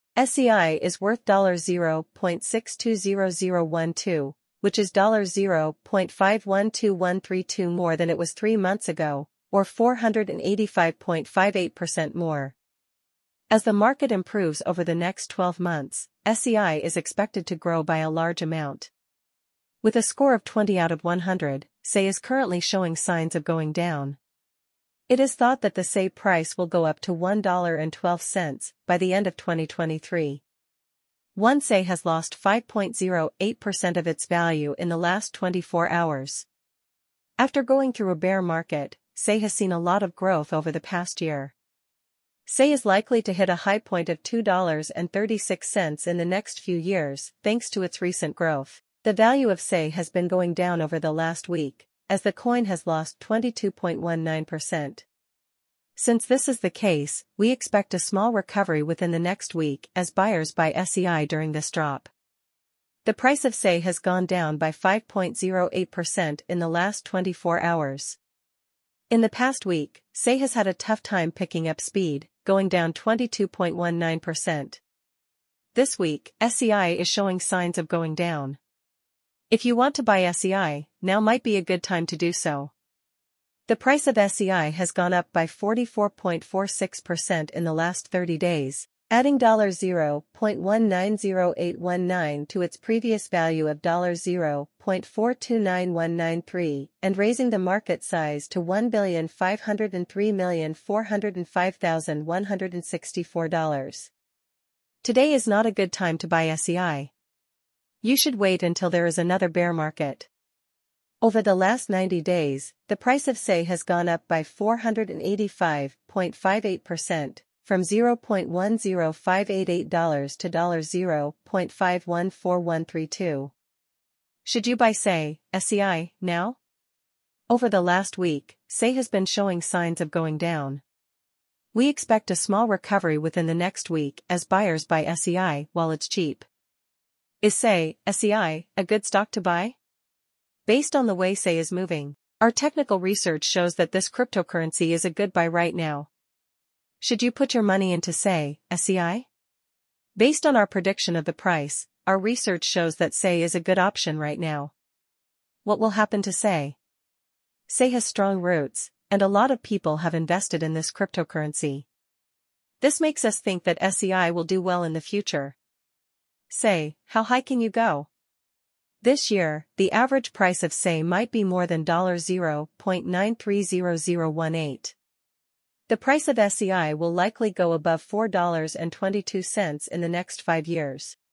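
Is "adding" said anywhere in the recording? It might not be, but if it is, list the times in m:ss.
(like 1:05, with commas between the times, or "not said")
1:29.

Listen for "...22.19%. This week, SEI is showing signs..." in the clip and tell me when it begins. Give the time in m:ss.
1:12.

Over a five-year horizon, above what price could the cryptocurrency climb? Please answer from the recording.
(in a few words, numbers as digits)
$4.22.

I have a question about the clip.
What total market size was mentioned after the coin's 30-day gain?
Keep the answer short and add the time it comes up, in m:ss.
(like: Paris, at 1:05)
$1,503,405,164, at 1:38.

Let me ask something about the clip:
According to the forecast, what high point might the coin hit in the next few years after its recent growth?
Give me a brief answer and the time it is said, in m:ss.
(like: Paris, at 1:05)
$2.36, at 0:44.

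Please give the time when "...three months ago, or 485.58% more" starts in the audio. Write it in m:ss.
0:08.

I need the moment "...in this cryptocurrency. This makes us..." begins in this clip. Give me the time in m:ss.
2:40.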